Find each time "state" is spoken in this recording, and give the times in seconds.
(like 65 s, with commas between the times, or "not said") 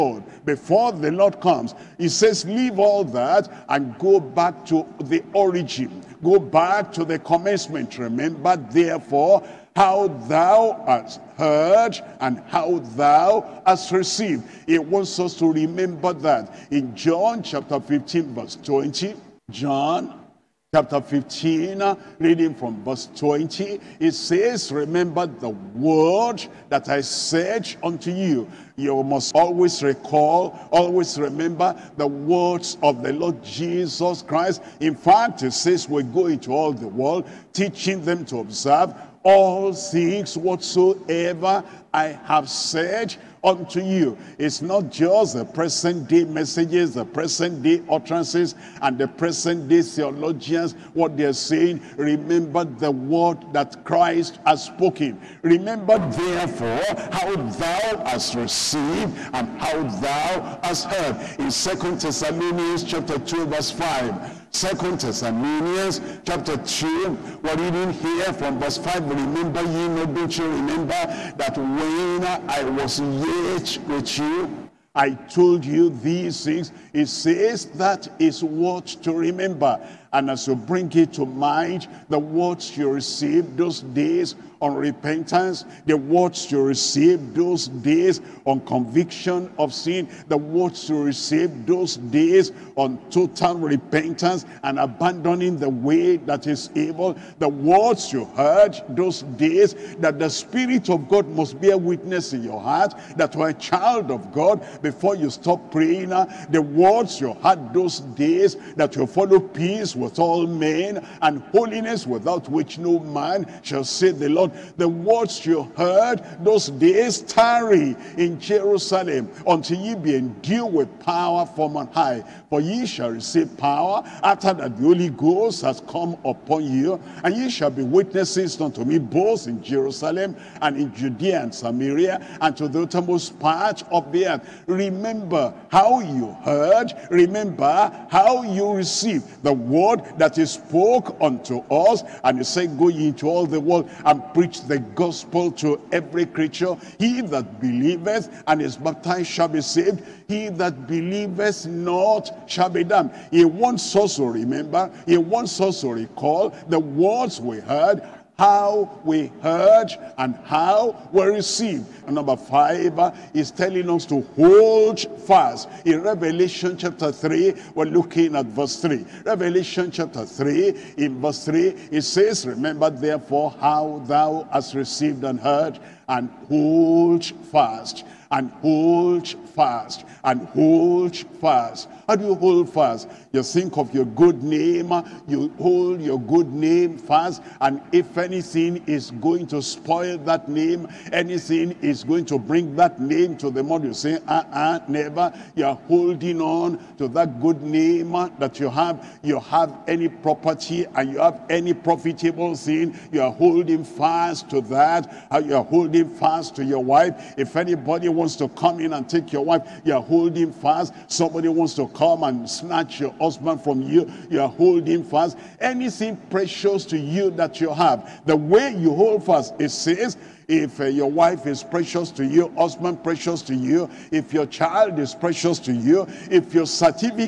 not said.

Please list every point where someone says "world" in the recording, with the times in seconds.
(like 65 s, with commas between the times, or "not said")
36 s, 143 s.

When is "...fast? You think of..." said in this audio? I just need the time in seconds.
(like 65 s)
182 s.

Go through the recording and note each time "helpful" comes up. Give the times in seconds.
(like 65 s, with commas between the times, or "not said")
not said.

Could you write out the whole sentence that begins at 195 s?
You're holding on to that good name that you have.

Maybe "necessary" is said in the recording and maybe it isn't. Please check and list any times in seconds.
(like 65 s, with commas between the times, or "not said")
not said.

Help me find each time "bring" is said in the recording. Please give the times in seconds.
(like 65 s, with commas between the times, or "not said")
80 s, 192 s.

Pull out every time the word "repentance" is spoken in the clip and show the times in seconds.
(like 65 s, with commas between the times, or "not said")
84 s, 93 s.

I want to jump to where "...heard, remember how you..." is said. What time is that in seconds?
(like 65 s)
136 s.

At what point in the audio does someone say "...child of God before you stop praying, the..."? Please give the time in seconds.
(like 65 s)
103 s.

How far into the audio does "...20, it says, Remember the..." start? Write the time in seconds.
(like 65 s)
23 s.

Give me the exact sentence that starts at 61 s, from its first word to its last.
In Second Thessalonians chapter 2 verse 5, Second Thessalonians chapter 2, we're reading here from verse 5.